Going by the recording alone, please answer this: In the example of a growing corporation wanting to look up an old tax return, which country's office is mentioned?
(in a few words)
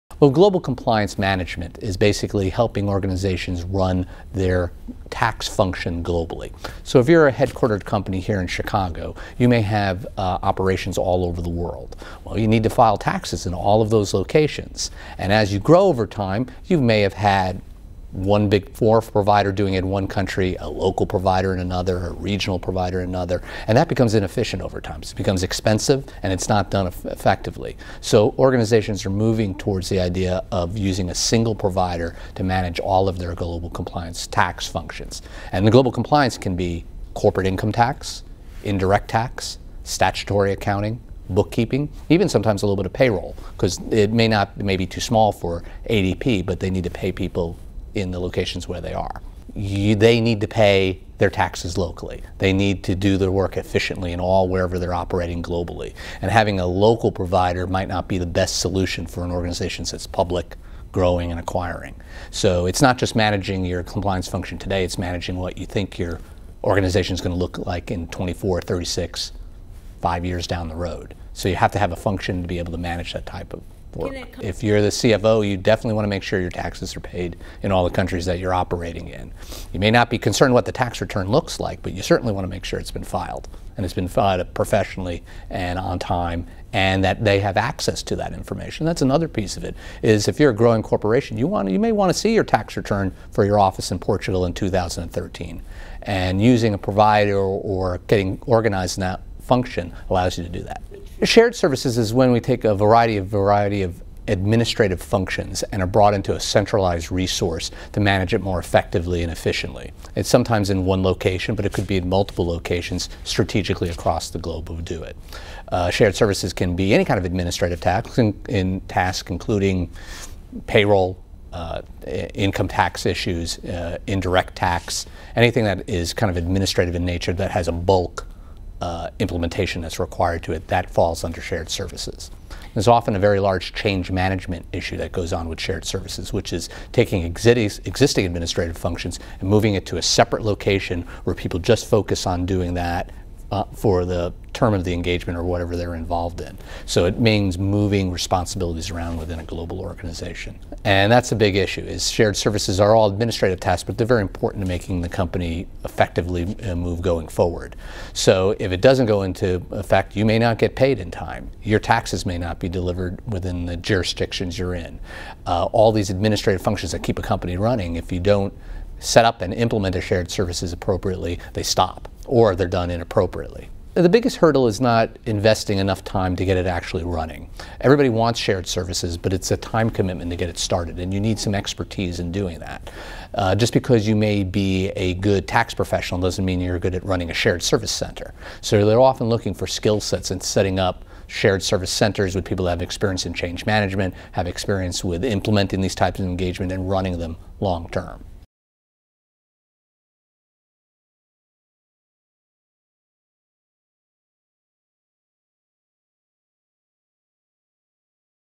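Portugal.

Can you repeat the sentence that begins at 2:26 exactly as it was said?
So it means moving responsibilities around within a global organization.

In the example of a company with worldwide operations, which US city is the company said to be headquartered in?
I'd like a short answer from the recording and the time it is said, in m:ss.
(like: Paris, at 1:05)
Chicago, at 0:08.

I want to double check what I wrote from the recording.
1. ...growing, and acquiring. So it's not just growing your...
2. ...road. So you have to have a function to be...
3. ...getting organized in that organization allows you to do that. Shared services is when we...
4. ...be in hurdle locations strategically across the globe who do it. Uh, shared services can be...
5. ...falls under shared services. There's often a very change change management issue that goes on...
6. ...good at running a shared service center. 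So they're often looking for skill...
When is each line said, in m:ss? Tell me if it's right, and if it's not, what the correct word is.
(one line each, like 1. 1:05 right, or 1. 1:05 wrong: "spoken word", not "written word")
1. 1:00 wrong: "managing", not "growing"
2. 1:10 right
3. 1:38 wrong: "function", not "organization"
4. 1:51 wrong: "multiple", not "hurdle"
5. 2:10 wrong: "large", not "change"
6. 3:06 right.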